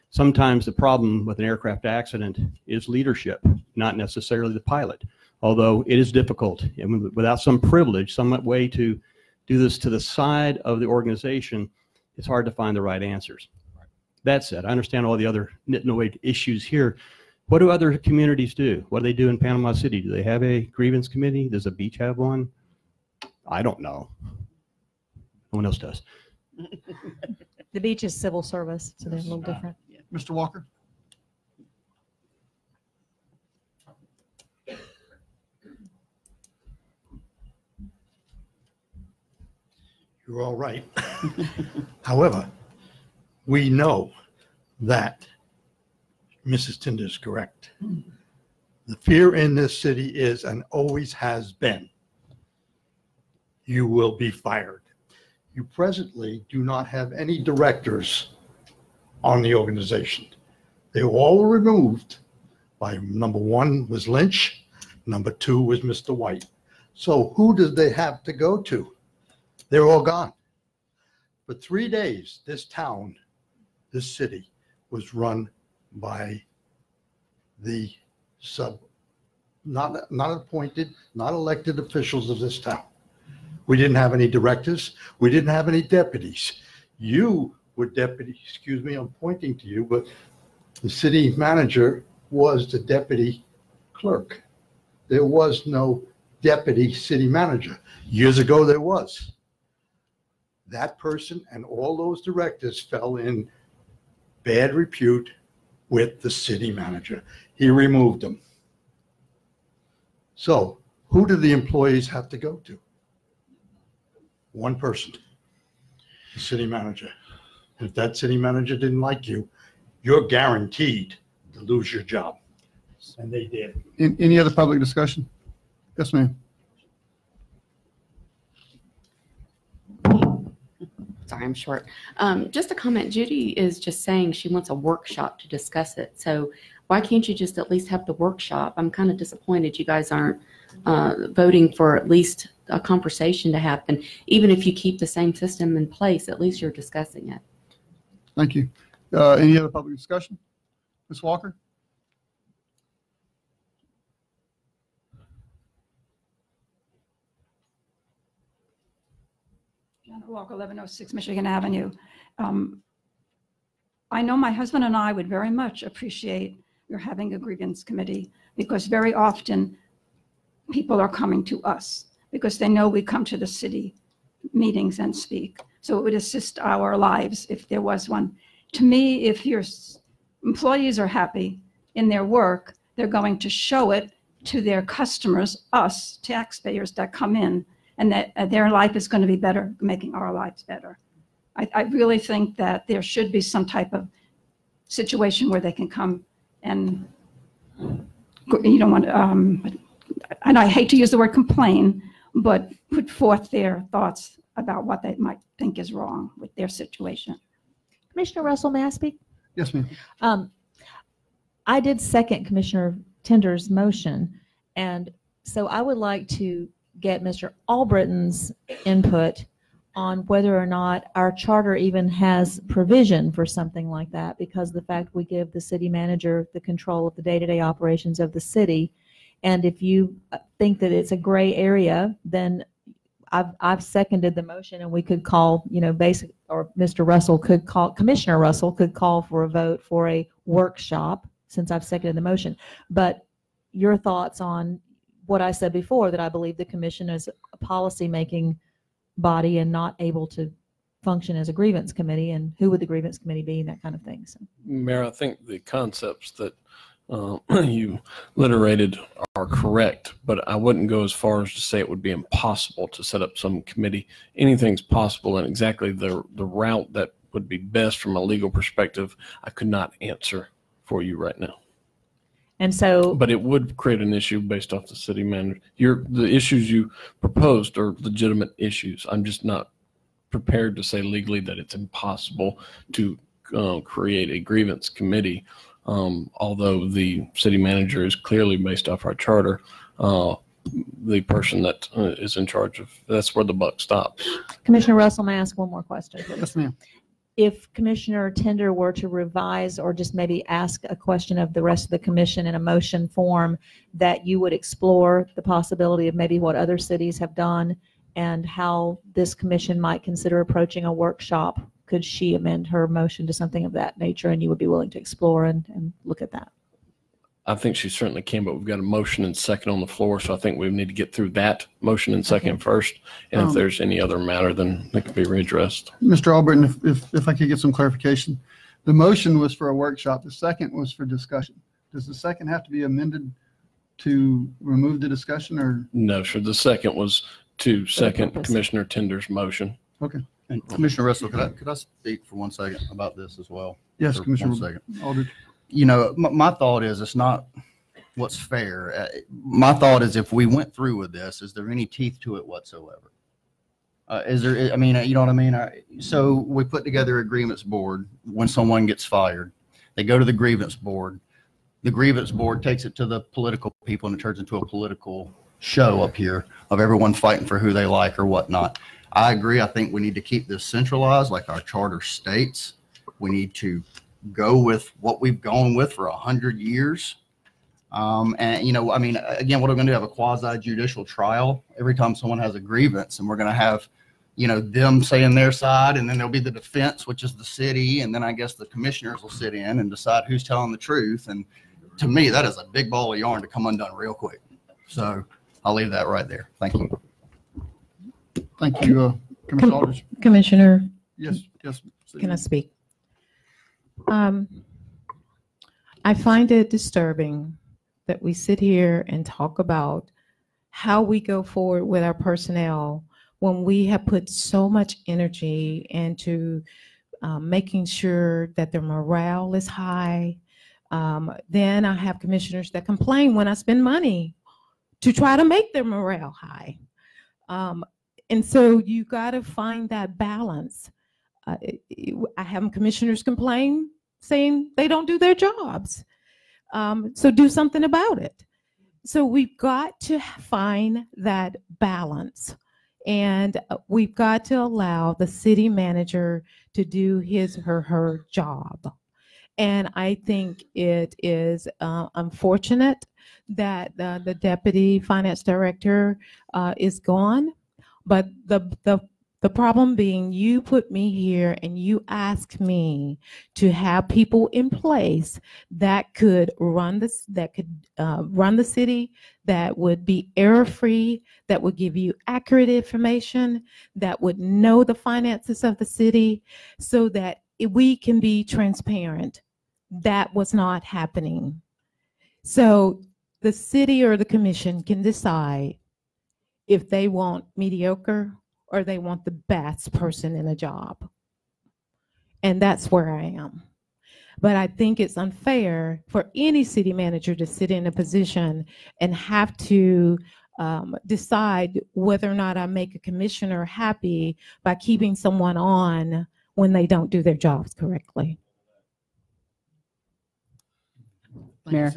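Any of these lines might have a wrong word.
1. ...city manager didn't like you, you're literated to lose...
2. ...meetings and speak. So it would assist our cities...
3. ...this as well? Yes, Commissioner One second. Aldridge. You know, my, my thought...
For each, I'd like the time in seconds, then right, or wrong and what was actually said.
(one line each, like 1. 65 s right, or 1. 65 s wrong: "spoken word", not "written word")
1. 118 s wrong: "guaranteed", not "literated"
2. 174 s wrong: "lives", not "cities"
3. 343 s right.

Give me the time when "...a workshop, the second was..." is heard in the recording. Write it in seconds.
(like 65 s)
329 s.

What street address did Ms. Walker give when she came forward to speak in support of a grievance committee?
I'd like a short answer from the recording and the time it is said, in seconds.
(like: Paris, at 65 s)
1106 Michigan Avenue, at 160 s.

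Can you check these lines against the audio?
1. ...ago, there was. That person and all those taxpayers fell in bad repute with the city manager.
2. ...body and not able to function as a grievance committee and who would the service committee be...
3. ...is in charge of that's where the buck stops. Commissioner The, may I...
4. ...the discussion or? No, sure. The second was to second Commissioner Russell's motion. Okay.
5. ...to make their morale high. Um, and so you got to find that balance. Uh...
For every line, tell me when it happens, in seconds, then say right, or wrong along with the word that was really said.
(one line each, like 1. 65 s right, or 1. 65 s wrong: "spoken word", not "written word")
1. 98 s wrong: "directors", not "taxpayers"
2. 249 s wrong: "grievance", not "service"
3. 292 s wrong: "Russell", not "The"
4. 335 s wrong: "Tinder", not "Russell"
5. 425 s right.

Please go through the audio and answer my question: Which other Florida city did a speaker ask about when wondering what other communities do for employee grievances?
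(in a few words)
Panama City.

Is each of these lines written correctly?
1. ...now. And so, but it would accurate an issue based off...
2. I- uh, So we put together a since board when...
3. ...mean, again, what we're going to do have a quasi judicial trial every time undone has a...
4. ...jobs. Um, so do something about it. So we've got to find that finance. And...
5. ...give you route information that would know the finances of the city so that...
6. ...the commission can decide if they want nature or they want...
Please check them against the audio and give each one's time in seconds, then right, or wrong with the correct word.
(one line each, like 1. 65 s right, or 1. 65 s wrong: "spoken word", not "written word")
1. 271 s wrong: "create", not "accurate"
2. 355 s wrong: "grievance", not "since"
3. 378 s wrong: "someone", not "undone"
4. 435 s wrong: "balance", not "finance"
5. 471 s wrong: "accurate", not "route"
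6. 484 s wrong: "mediocre", not "nature".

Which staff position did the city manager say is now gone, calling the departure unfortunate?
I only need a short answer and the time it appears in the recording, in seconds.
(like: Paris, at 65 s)
deputy finance director, at 454 s.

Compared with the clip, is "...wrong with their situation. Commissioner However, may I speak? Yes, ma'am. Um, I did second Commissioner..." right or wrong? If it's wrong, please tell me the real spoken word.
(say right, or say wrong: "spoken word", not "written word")
wrong: "Russell", not "However".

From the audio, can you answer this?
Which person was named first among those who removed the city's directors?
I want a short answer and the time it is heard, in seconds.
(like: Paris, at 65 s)
Lynch, at 64 s.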